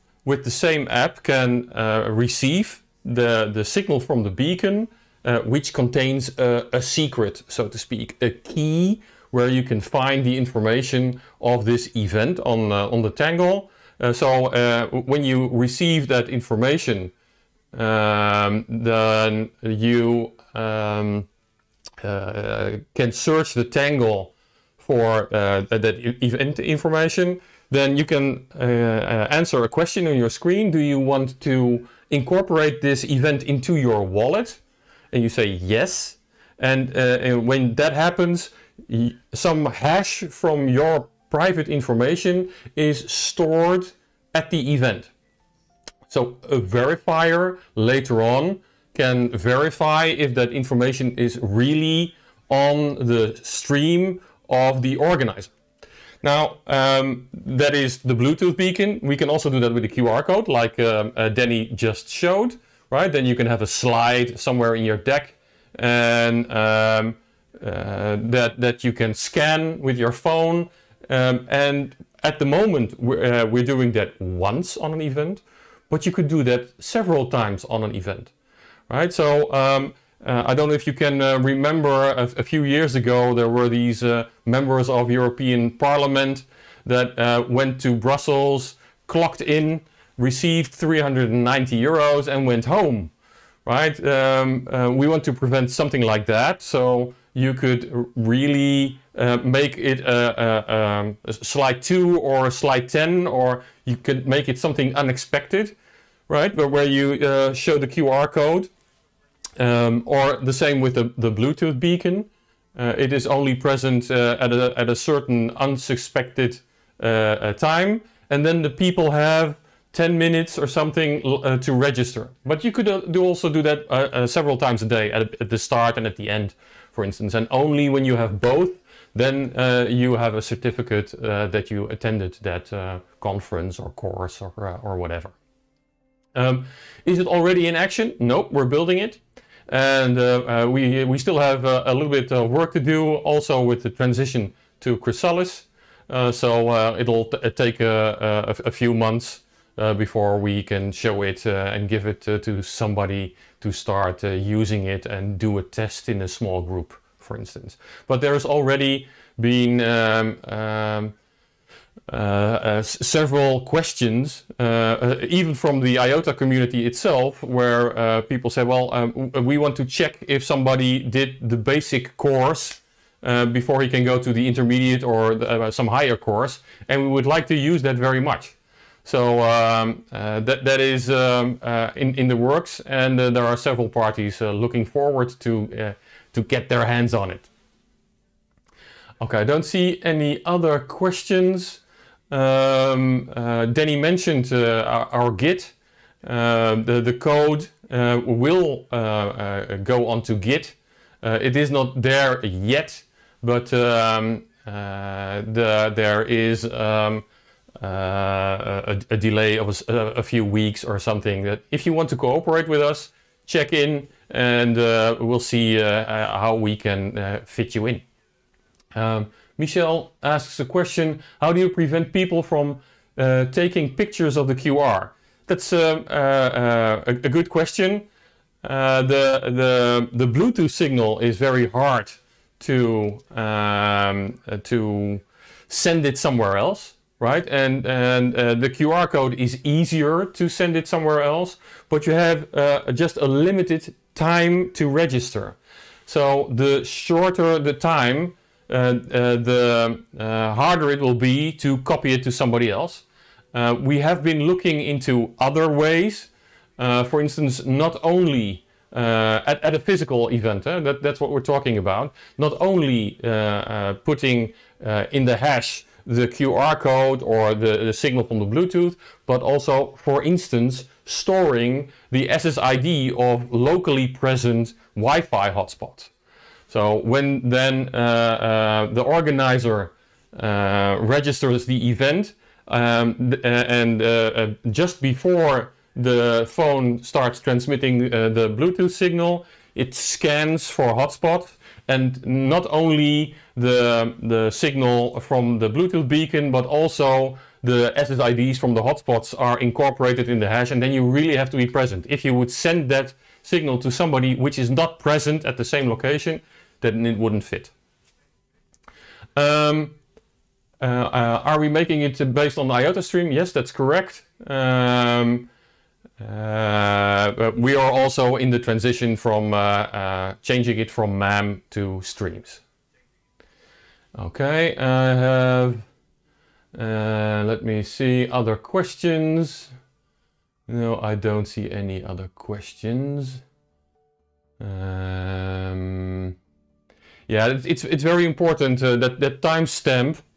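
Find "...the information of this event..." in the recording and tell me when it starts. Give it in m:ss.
0:10.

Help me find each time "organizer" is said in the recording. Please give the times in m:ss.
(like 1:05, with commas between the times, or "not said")
0:54, 4:39.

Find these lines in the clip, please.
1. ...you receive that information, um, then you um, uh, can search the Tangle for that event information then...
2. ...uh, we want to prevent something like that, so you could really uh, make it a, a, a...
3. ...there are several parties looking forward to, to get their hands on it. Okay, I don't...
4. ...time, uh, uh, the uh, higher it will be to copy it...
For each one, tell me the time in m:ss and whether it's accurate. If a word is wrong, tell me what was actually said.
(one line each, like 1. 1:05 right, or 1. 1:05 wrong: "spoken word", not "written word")
1. 0:15 right
2. 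1:34 right
3. 3:03 right
4. 4:07 wrong: "harder", not "higher".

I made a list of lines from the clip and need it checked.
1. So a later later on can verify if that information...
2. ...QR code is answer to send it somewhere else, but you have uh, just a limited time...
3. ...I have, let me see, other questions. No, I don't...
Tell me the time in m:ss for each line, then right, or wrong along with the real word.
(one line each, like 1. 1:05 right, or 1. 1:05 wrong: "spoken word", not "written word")
1. 0:46 wrong: "verifier", not "later"
2. 3:58 wrong: "easier", not "answer"
3. 5:24 right.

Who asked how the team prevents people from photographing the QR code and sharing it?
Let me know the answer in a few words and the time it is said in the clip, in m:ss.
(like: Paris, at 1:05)
Michelle, at 3:39.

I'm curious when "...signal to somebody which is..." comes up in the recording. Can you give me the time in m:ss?
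5:03.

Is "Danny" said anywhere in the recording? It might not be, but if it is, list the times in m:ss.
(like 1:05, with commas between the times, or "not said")
1:01, 3:13.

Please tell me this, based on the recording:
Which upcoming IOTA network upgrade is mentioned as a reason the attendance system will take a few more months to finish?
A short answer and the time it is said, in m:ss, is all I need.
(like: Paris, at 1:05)
Chrysalis, at 2:24.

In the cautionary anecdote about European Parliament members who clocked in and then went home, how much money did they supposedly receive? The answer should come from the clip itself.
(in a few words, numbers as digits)
390 euros.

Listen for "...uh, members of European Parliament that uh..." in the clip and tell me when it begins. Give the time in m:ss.
1:24.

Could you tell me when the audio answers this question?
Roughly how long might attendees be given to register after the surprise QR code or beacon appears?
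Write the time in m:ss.
1:59.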